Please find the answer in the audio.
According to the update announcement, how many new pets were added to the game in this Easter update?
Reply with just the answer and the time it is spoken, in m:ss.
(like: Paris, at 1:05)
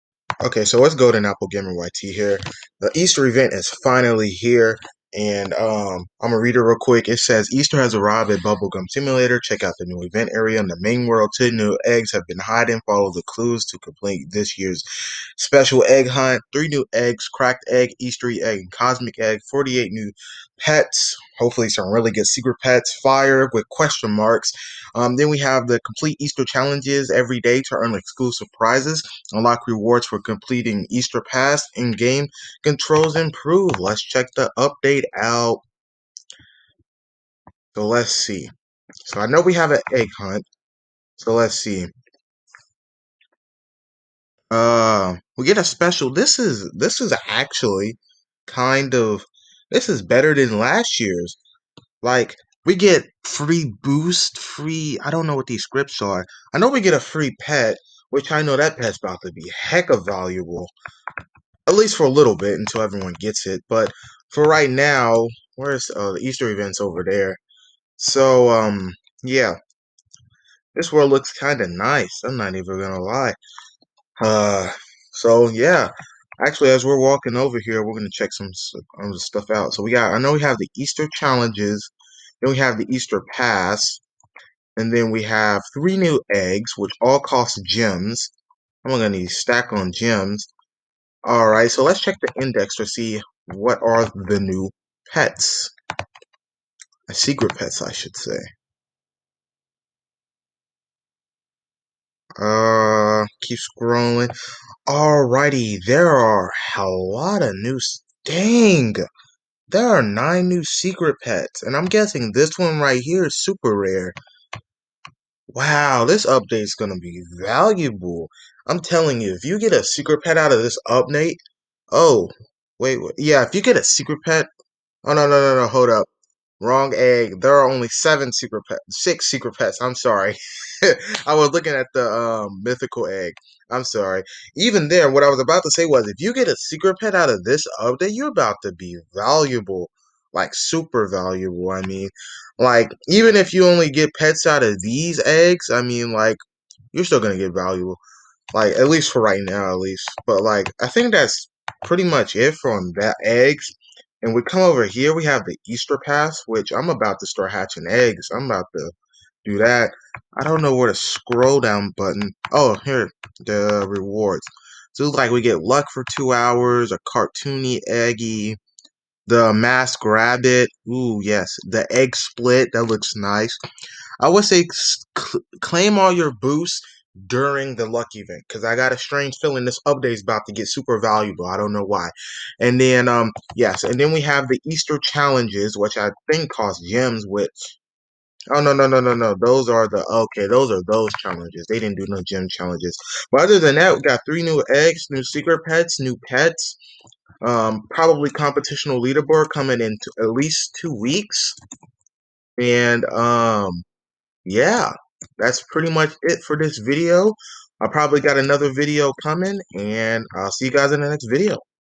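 48, at 0:19.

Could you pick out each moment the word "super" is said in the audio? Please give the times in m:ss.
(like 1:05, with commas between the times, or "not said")
1:53, 2:20, 3:00.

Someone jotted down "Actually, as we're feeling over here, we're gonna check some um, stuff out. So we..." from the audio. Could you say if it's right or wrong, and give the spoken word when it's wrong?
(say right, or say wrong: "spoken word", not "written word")
wrong: "walking", not "feeling".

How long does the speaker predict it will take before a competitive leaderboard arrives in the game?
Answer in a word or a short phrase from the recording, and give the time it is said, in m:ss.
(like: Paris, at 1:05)
at least two weeks, at 3:20.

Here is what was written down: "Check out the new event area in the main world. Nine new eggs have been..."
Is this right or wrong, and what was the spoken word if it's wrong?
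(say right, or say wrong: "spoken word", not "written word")
wrong: "Two", not "Nine".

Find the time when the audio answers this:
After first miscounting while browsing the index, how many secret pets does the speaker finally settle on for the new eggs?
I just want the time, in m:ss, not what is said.
2:09.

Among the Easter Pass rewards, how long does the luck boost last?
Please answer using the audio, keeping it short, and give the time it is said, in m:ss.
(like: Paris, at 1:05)
2 hours, at 2:46.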